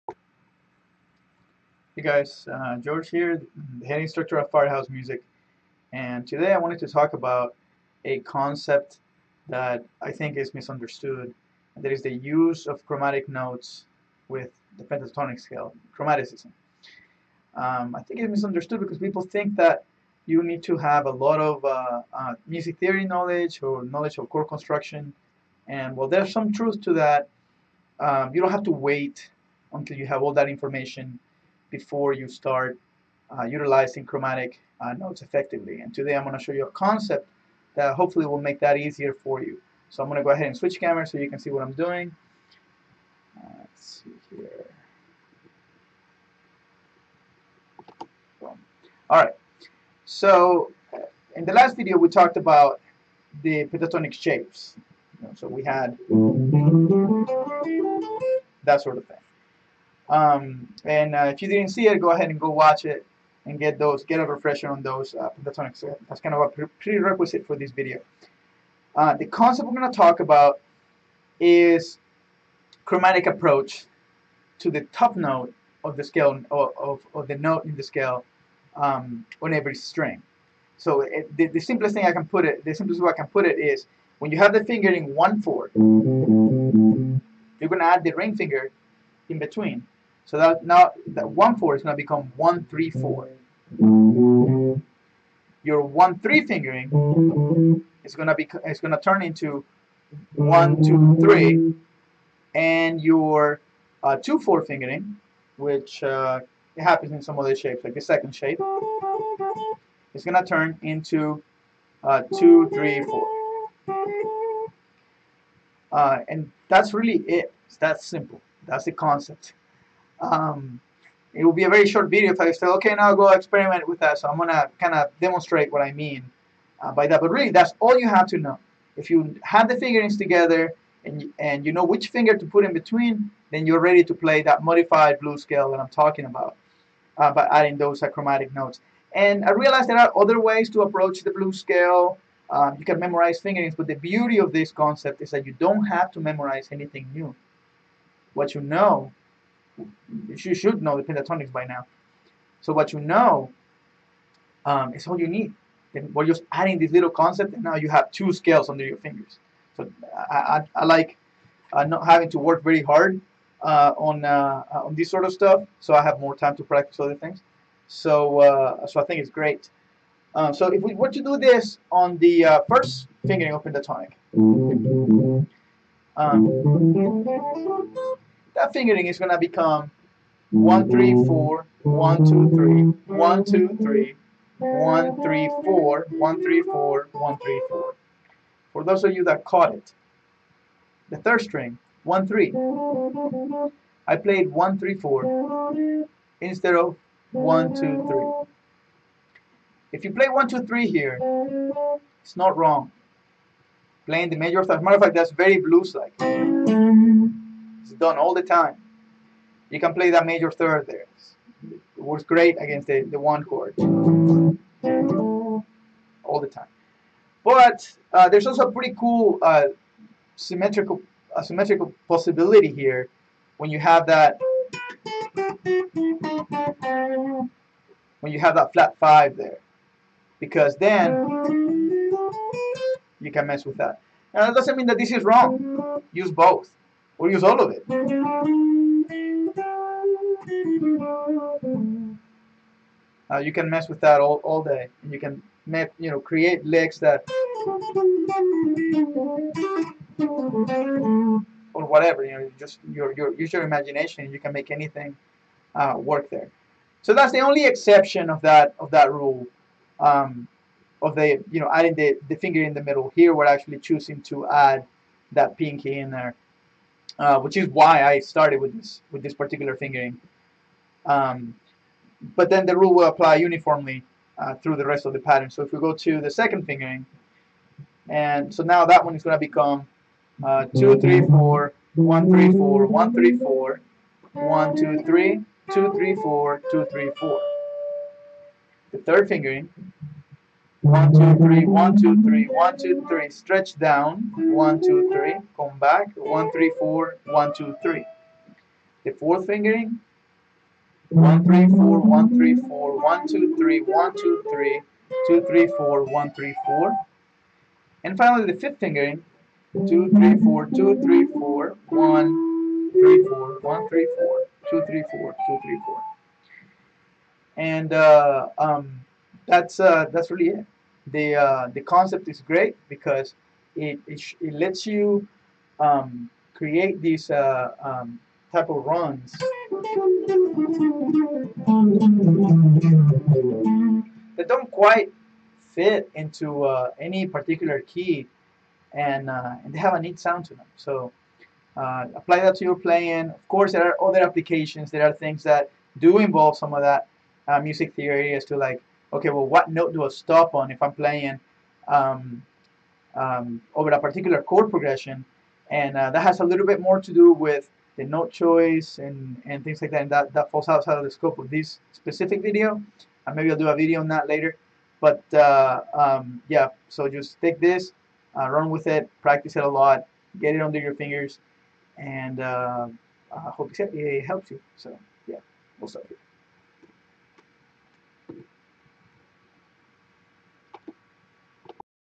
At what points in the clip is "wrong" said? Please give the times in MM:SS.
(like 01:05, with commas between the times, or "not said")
03:22, 03:55.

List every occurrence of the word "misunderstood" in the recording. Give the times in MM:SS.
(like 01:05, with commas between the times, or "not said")
00:10, 00:18.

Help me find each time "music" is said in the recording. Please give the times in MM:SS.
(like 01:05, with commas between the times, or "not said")
00:04, 00:22, 05:47.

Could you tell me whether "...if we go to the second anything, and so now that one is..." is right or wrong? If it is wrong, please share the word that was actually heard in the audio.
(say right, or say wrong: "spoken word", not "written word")
wrong: "fingering", not "anything".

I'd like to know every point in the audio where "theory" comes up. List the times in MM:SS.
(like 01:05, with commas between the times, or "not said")
00:22, 05:47.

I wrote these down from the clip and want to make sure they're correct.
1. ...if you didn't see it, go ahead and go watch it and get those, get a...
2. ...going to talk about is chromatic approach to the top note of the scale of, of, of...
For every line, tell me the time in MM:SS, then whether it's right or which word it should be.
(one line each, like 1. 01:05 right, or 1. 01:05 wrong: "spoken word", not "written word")
1. 01:01 right
2. 01:09 right.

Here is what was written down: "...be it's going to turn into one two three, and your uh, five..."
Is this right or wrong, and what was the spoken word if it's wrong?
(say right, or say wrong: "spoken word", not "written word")
wrong: "two", not "five".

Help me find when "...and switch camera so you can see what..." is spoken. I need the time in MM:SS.
00:40.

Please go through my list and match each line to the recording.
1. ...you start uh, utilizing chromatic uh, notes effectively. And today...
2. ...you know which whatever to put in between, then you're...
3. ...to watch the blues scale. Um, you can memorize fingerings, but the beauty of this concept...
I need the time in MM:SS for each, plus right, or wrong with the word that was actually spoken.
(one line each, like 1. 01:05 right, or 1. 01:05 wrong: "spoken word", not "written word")
1. 00:32 right
2. 02:11 wrong: "finger", not "whatever"
3. 02:20 wrong: "approach", not "watch".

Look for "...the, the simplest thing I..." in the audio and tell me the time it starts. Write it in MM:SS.
01:21.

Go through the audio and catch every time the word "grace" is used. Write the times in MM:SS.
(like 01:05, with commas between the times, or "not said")
not said.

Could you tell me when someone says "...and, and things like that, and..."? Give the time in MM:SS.
05:58.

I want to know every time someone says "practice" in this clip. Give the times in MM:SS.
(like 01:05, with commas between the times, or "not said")
02:46, 06:09.